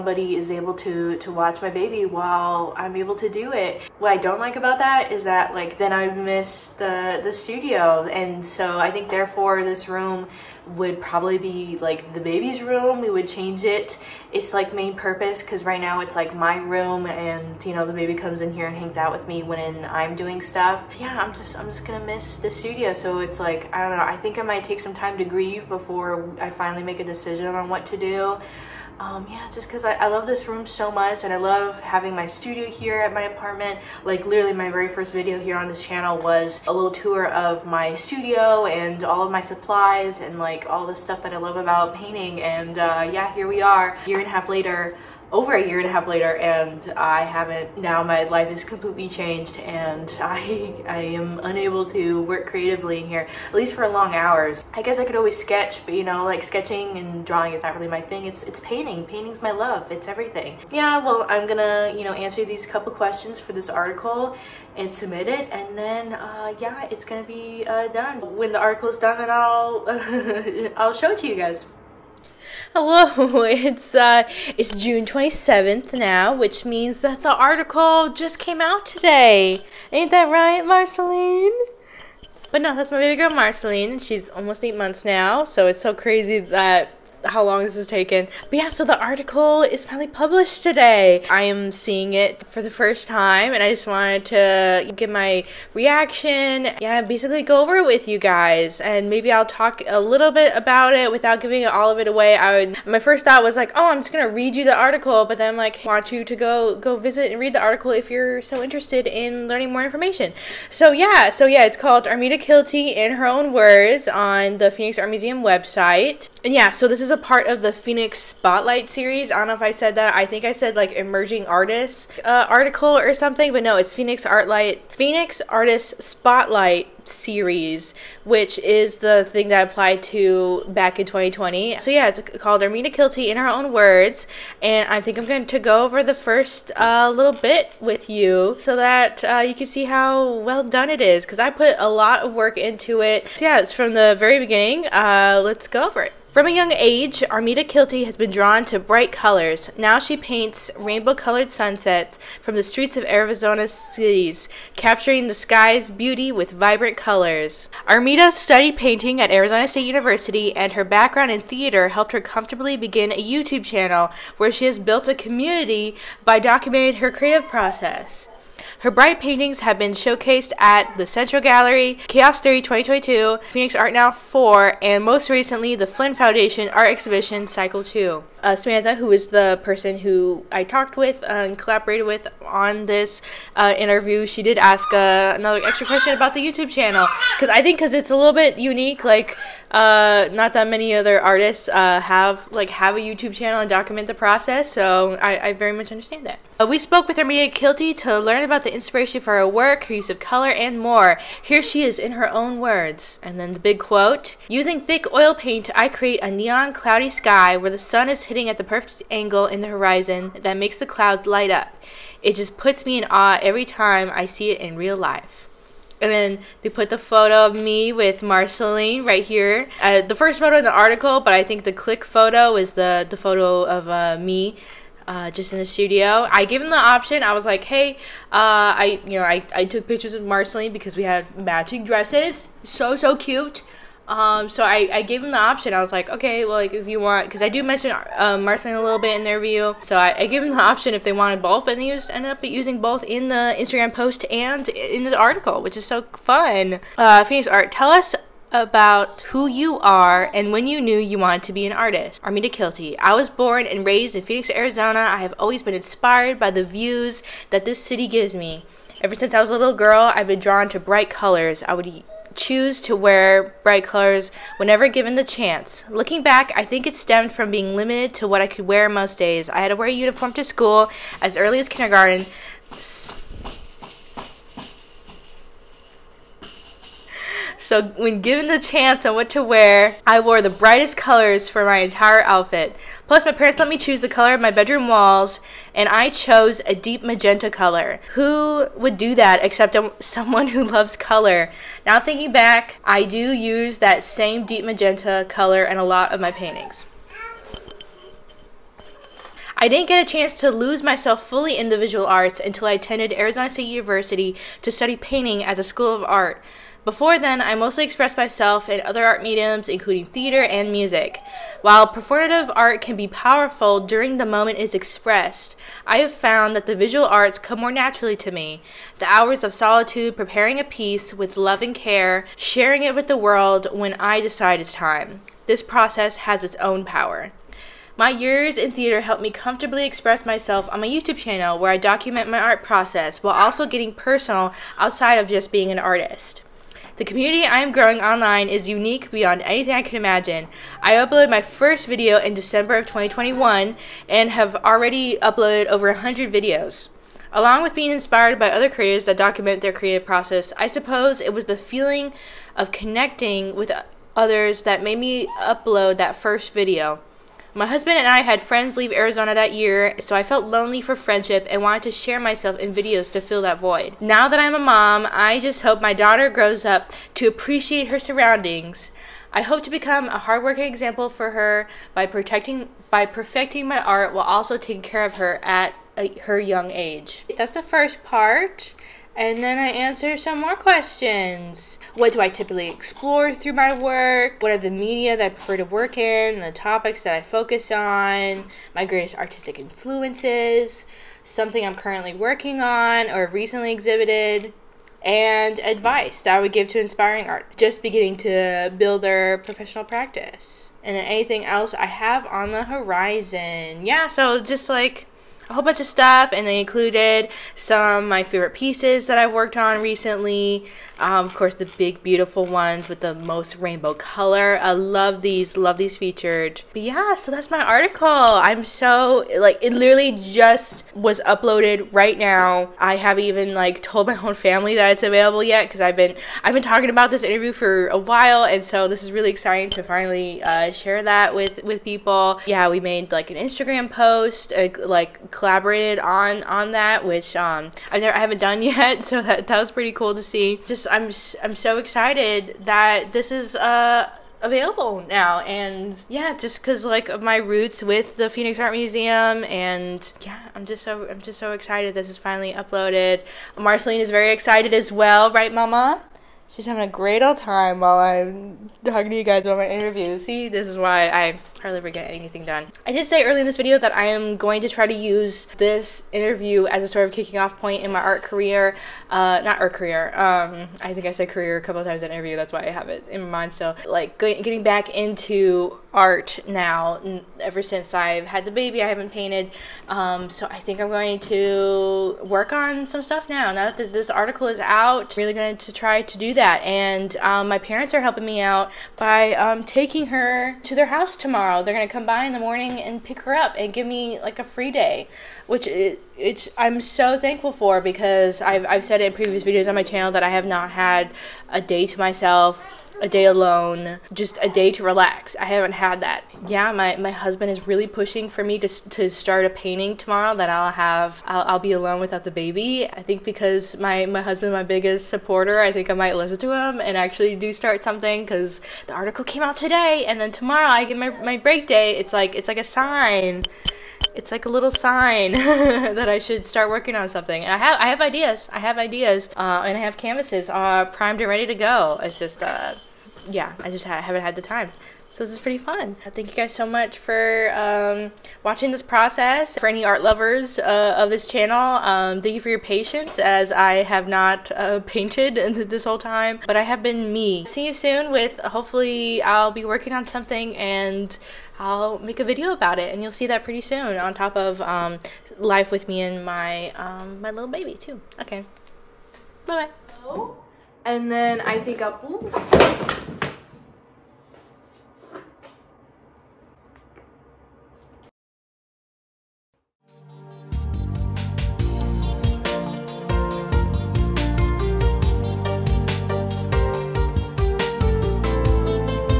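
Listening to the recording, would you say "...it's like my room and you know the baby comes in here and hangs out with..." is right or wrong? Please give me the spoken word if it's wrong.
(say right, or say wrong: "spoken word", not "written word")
right.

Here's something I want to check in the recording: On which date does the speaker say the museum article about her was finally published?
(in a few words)
June 27th.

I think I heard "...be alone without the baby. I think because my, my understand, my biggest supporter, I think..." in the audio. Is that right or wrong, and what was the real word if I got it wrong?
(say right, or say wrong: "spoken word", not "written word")
wrong: "husband", not "understand".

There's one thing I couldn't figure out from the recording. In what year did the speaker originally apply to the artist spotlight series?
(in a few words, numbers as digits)
2020.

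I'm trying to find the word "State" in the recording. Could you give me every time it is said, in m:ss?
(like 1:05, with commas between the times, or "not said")
2:39, 5:03.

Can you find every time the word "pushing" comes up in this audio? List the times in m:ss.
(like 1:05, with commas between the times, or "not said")
8:27.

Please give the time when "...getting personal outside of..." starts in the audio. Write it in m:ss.
5:33.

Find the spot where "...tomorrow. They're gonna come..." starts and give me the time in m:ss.
8:11.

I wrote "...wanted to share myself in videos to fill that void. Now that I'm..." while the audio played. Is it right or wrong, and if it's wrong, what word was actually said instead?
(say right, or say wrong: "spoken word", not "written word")
right.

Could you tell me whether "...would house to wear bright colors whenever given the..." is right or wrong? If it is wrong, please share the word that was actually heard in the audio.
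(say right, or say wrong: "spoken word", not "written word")
wrong: "choose", not "house".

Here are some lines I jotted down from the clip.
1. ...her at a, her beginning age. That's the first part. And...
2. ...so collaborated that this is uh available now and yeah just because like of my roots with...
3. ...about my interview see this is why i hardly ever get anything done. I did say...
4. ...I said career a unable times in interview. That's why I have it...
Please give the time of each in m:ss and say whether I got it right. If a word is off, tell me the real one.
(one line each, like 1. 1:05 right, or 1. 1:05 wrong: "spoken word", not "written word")
1. 6:15 wrong: "young", not "beginning"
2. 7:21 wrong: "excited", not "collaborated"
3. 7:39 right
4. 7:51 wrong: "couple", not "unable".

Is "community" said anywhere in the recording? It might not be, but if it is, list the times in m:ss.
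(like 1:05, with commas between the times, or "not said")
2:45, 5:37.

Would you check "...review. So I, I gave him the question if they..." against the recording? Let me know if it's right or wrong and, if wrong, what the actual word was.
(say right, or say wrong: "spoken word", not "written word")
wrong: "option", not "question".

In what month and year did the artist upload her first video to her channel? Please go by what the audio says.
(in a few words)
December 2021.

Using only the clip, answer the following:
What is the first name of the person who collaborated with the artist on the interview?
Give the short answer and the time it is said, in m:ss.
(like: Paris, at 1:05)
Samantha, at 2:58.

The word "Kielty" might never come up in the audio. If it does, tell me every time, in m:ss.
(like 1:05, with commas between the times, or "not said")
1:52, 2:12, 2:27, 3:17, 4:12.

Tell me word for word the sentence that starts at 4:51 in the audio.
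Now, thinking back, I do use that same deep magenta color in a lot of my paintings.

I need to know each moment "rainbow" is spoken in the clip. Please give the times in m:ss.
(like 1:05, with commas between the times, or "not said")
2:30, 6:53.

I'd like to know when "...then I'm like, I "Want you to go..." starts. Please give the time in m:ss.
1:45.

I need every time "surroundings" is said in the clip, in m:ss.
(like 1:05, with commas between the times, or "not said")
6:07.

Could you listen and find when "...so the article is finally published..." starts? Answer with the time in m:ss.
1:28.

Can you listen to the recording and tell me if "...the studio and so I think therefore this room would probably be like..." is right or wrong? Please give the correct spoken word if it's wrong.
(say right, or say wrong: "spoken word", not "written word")
right.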